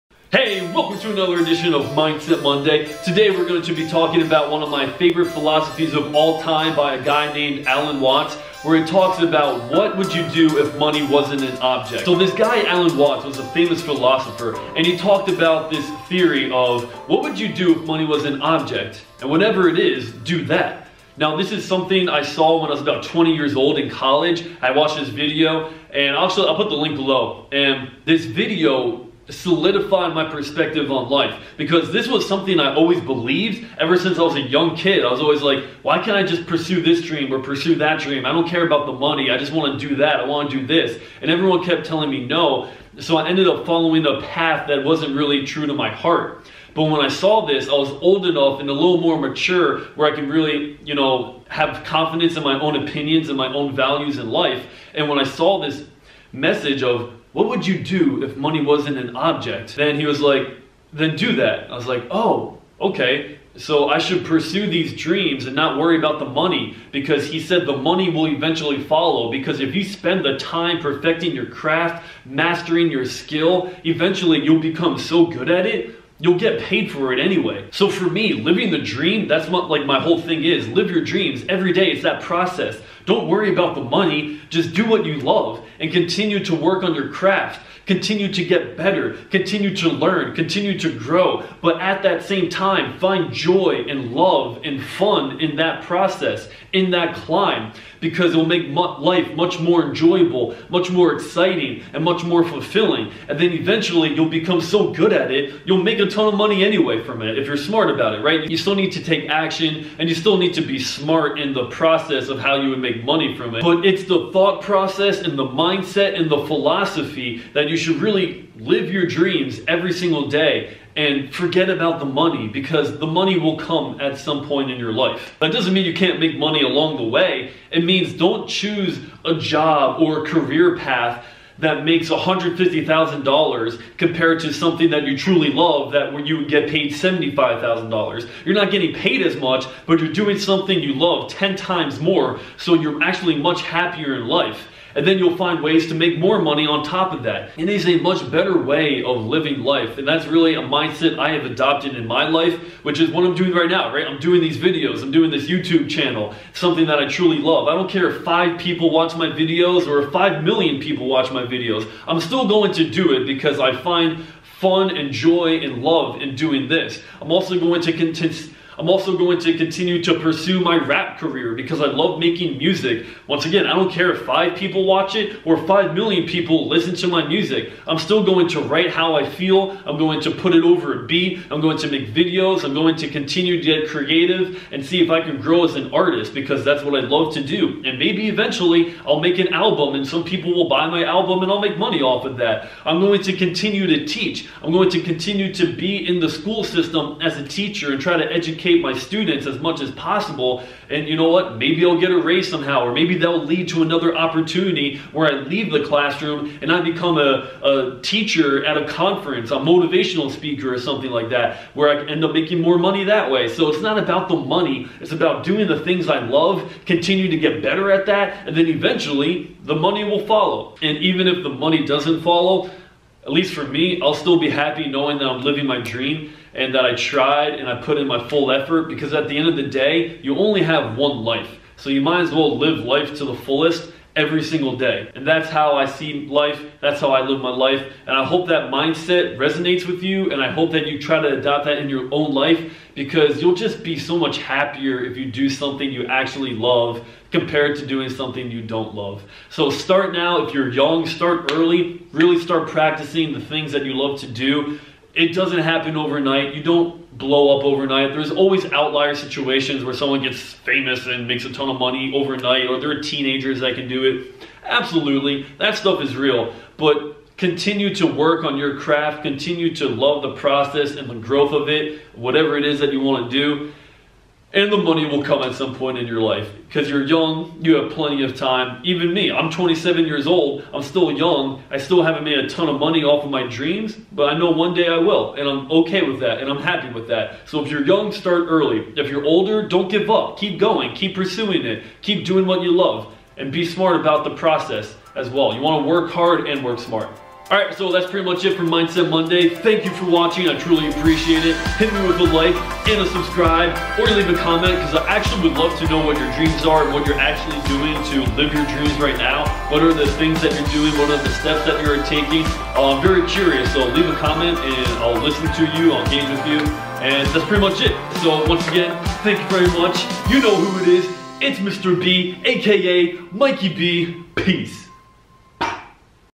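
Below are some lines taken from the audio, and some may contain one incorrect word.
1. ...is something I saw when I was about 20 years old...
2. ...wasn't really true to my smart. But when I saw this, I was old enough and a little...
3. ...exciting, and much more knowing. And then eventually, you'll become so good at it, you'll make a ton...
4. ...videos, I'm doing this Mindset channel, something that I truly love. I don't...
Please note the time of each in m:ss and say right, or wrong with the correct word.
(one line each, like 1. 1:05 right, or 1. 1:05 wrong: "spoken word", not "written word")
1. 0:21 right
2. 0:44 wrong: "heart", not "smart"
3. 1:41 wrong: "fulfilling", not "knowing"
4. 2:34 wrong: "YouTube", not "Mindset".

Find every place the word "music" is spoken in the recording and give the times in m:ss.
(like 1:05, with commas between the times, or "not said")
2:52, 2:57.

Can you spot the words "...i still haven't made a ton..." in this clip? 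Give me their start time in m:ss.
4:41.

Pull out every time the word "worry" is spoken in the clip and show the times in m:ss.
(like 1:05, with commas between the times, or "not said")
1:05, 1:23.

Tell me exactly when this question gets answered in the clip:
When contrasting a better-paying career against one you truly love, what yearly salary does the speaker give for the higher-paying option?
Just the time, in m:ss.
2:12.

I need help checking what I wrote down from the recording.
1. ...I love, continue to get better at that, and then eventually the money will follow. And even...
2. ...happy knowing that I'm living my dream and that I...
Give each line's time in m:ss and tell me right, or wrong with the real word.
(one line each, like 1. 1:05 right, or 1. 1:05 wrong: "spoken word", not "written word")
1. 3:36 right
2. 3:44 right.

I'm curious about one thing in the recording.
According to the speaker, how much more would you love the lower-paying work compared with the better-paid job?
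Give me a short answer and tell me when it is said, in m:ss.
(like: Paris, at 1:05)
10 times more, at 2:21.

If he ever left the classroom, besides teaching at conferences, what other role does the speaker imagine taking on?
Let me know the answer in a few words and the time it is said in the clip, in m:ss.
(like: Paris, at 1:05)
motivational speaker, at 3:29.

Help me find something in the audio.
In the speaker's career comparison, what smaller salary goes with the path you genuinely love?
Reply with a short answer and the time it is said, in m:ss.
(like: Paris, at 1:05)
$75,000, at 2:16.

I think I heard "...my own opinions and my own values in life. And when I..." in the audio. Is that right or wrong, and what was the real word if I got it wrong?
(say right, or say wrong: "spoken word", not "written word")
right.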